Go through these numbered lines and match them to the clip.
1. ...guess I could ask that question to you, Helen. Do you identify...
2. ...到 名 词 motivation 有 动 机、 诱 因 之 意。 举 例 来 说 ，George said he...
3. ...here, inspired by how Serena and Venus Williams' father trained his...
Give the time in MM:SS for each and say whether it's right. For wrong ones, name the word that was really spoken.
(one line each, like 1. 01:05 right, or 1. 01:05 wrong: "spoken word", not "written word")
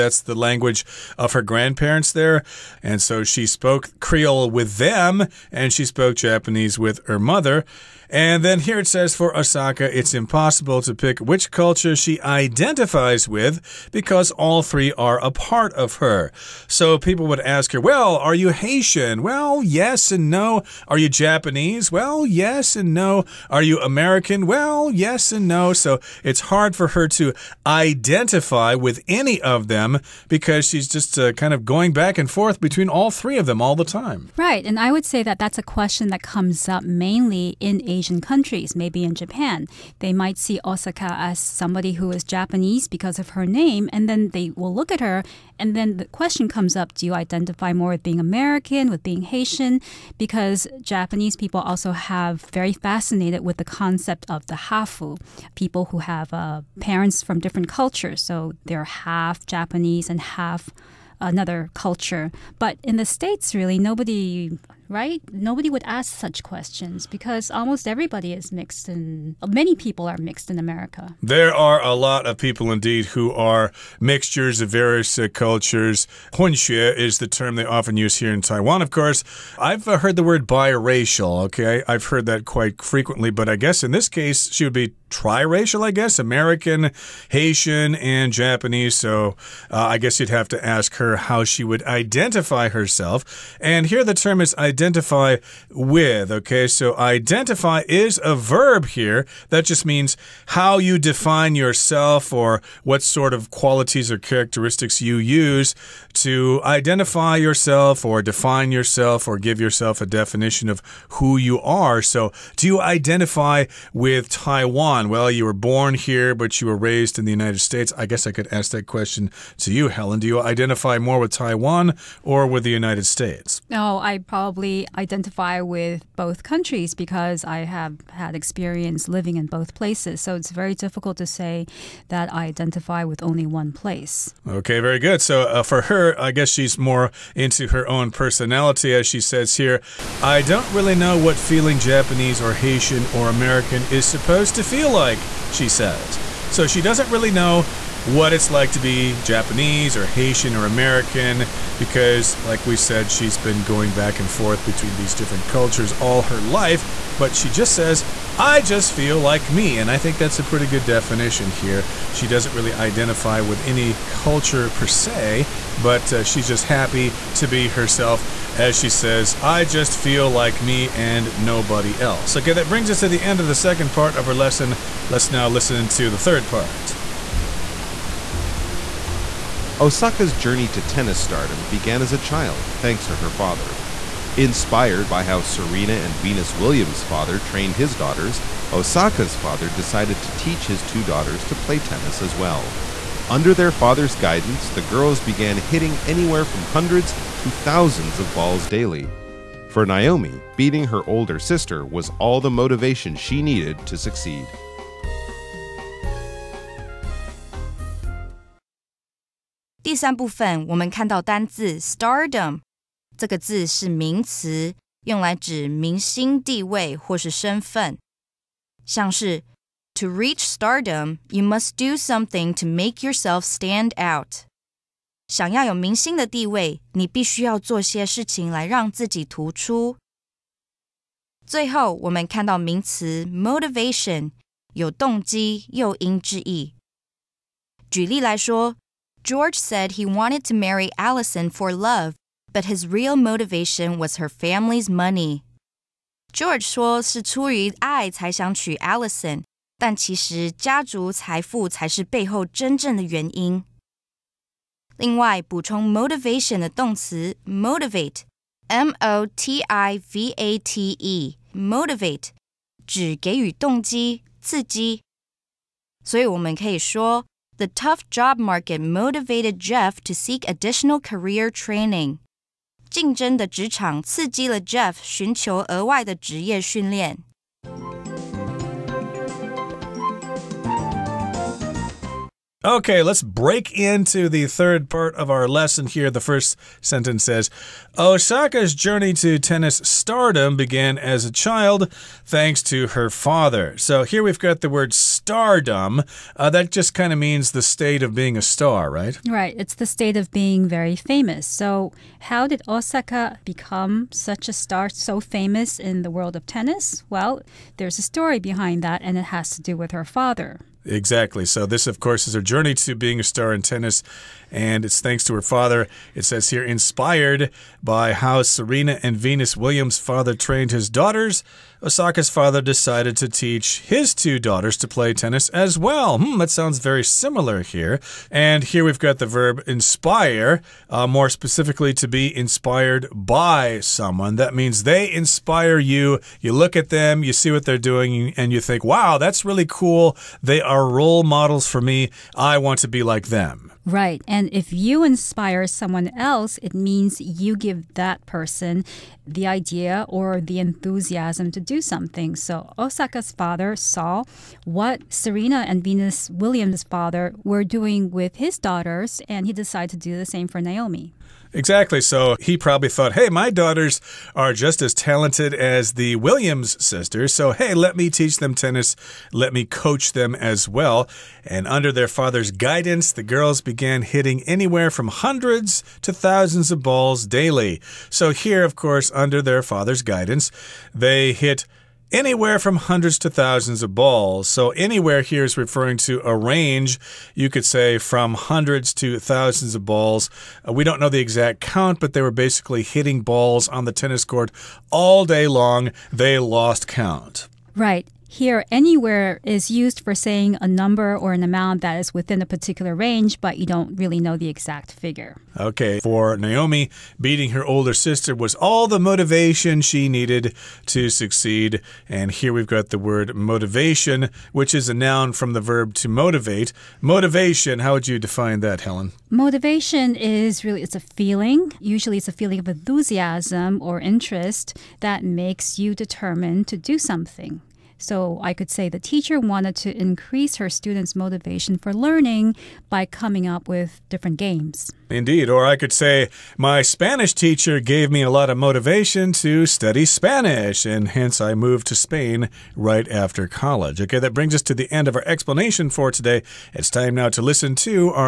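1. 01:58 right
2. 03:52 right
3. 05:16 right.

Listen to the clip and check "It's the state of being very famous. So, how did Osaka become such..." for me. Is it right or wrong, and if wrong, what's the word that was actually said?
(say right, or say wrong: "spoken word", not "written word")
right.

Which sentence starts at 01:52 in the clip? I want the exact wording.
So do you identify with Taiwan?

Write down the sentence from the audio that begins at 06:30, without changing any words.
Uh, we don't know the exact count, but they were basically hitting balls on the tennis court all day long.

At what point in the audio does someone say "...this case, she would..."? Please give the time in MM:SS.
01:23.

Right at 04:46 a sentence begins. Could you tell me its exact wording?
The first sentence says Osaka's journey to tennis stardom began as a child thanks to her father.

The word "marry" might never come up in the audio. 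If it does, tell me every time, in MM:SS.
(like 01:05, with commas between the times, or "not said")
04:00.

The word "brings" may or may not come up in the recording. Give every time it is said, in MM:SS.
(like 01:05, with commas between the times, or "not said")
02:52, 07:24.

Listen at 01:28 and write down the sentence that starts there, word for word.
So uh, I guess you'd have to ask her how she would identify herself.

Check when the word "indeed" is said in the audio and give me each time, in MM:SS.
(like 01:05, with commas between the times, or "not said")
01:12, 07:15.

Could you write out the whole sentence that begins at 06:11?
And under their father's guidance, the girls began hitting anywhere from hundreds to thousands of balls daily.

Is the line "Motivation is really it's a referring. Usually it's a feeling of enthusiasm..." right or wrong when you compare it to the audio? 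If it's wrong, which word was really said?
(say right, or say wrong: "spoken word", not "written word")
wrong: "feeling", not "referring".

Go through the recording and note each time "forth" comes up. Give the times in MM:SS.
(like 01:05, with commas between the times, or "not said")
00:32, 02:34.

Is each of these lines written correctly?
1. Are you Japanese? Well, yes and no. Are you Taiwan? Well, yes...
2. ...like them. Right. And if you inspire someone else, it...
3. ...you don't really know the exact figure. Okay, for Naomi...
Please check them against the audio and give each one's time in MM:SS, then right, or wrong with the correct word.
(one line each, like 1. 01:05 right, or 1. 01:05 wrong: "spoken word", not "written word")
1. 00:20 wrong: "American", not "Taiwan"
2. 05:43 right
3. 06:43 right.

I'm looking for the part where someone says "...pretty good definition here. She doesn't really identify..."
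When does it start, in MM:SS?
02:40.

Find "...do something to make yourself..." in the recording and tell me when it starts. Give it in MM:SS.
03:41.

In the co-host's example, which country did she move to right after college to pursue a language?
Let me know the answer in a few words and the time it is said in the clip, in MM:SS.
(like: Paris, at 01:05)
Spain, at 07:21.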